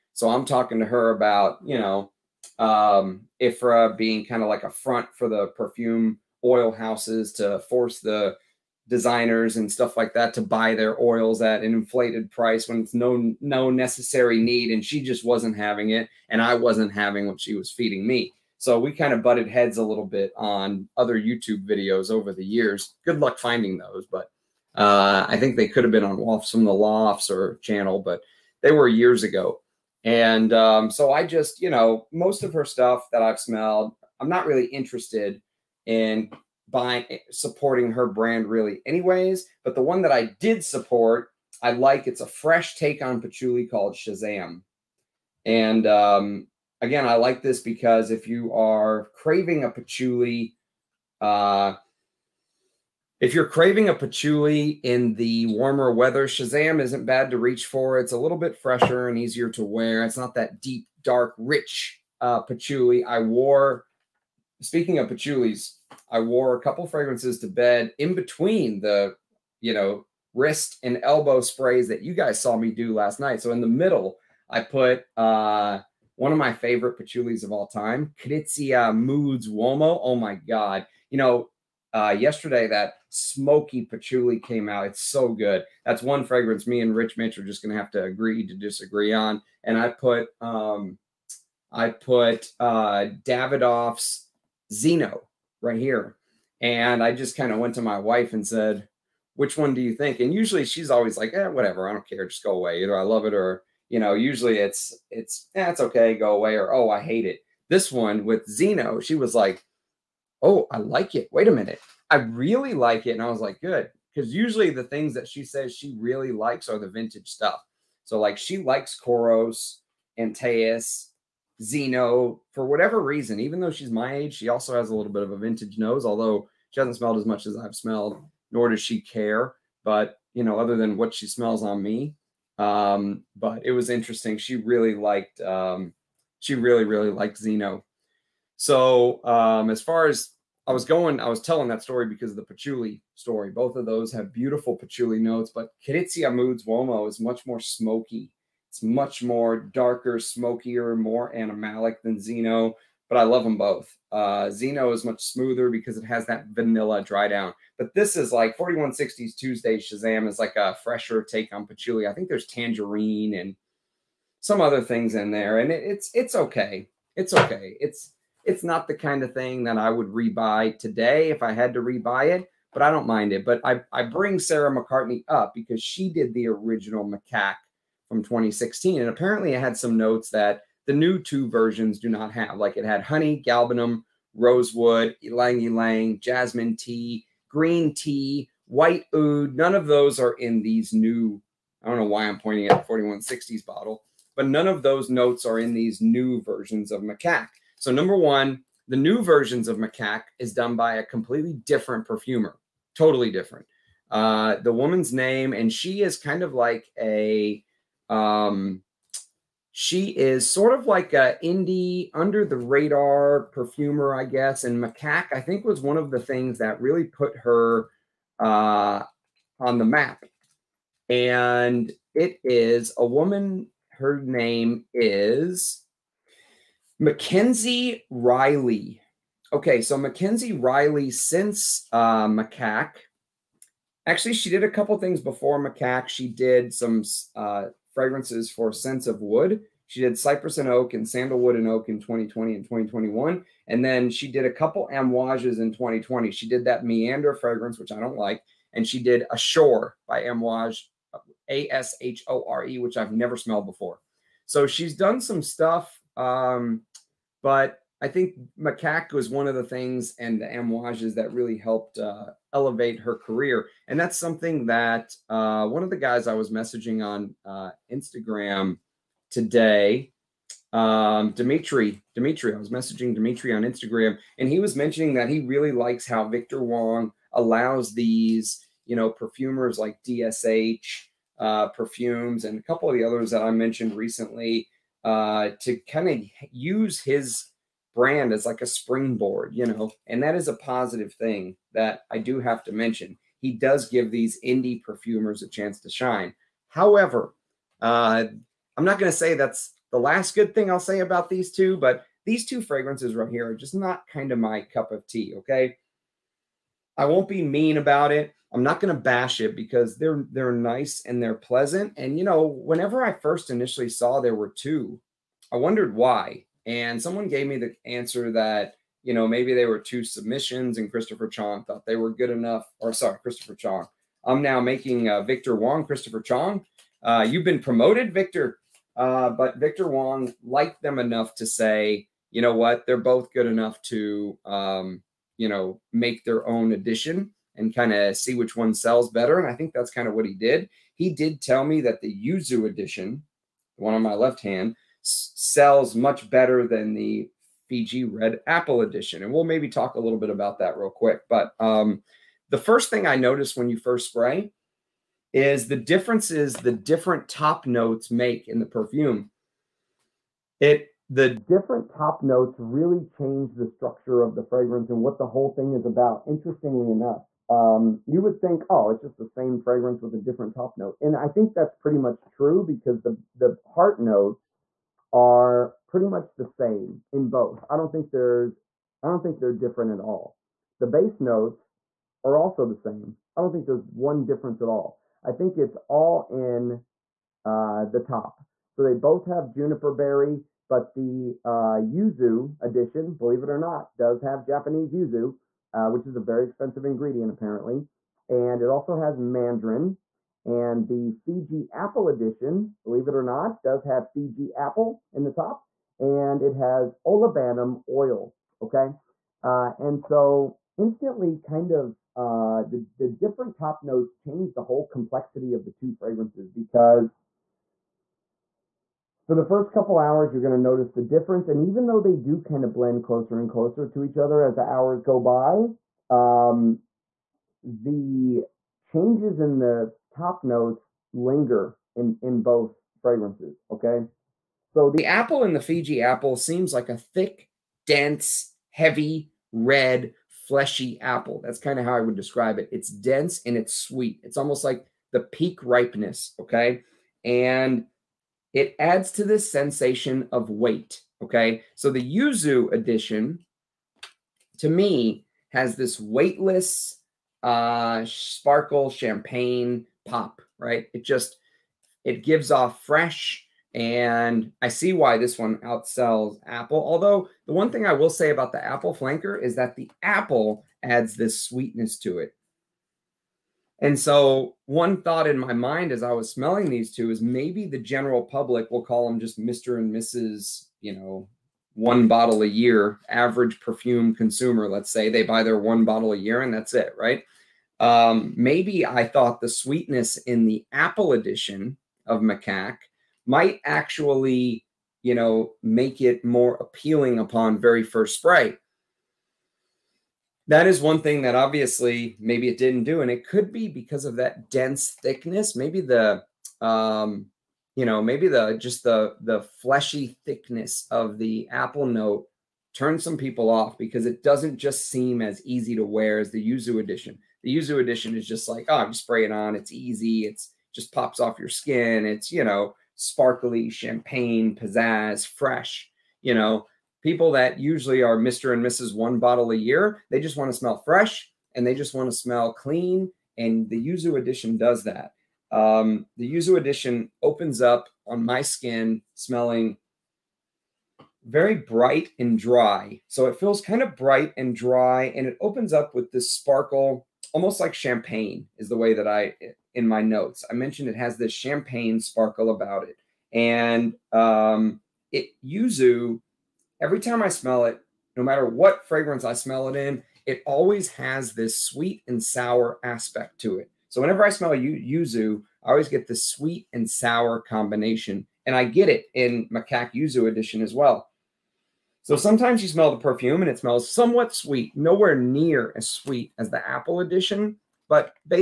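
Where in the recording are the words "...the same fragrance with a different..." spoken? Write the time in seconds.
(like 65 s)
369 s.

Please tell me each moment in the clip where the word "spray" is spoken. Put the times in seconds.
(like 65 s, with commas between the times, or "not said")
71 s, 354 s, 498 s, 518 s.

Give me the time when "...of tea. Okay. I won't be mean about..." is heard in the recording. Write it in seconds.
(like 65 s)
304 s.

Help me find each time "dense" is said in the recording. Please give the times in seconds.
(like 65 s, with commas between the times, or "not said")
437 s, 442 s, 504 s.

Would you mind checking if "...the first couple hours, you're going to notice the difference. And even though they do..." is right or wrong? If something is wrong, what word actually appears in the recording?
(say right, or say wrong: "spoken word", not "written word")
right.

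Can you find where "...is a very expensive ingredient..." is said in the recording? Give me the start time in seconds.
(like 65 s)
396 s.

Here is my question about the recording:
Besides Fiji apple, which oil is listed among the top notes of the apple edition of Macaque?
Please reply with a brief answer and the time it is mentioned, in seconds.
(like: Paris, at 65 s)
Olibanum oil, at 407 s.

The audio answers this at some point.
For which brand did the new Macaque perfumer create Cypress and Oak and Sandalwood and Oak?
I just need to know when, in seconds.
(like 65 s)
238 s.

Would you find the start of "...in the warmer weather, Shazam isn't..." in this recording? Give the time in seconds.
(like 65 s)
54 s.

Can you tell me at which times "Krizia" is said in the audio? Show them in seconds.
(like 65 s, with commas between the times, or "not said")
78 s, 145 s.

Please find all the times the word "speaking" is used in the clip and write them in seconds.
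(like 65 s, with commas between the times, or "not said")
64 s.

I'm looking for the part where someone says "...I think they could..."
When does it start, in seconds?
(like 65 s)
25 s.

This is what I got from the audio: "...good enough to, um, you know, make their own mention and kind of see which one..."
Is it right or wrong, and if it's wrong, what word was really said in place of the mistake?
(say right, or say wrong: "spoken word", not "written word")
wrong: "addition", not "mention".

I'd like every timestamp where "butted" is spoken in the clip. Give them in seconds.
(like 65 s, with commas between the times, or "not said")
19 s.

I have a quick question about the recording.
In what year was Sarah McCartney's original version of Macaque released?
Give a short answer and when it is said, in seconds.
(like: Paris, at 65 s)
2016, at 178 s.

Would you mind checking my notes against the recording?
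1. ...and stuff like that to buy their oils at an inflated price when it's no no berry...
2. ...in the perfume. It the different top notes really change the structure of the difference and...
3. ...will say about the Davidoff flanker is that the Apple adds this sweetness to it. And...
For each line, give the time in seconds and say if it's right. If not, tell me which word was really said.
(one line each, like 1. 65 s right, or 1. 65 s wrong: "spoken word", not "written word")
1. 9 s wrong: "necessary", not "berry"
2. 358 s wrong: "fragrance", not "difference"
3. 467 s wrong: "Apple", not "Davidoff".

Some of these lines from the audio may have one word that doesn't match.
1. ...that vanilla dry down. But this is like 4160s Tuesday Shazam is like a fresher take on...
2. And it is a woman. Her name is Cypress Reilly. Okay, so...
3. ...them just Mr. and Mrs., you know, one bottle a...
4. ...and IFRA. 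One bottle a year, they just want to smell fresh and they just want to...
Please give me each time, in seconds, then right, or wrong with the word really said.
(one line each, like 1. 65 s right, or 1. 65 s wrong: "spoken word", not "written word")
1. 156 s right
2. 221 s wrong: "Mackenzie", not "Cypress"
3. 479 s right
4. 528 s wrong: "Mrs", not "IFRA".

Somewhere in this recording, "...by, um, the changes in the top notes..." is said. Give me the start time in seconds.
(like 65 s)
425 s.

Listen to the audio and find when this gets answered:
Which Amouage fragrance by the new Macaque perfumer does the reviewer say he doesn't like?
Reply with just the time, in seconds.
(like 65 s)
246 s.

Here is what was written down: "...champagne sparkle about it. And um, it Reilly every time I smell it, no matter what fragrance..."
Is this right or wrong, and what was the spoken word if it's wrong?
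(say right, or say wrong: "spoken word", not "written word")
wrong: "Yuzu", not "Reilly".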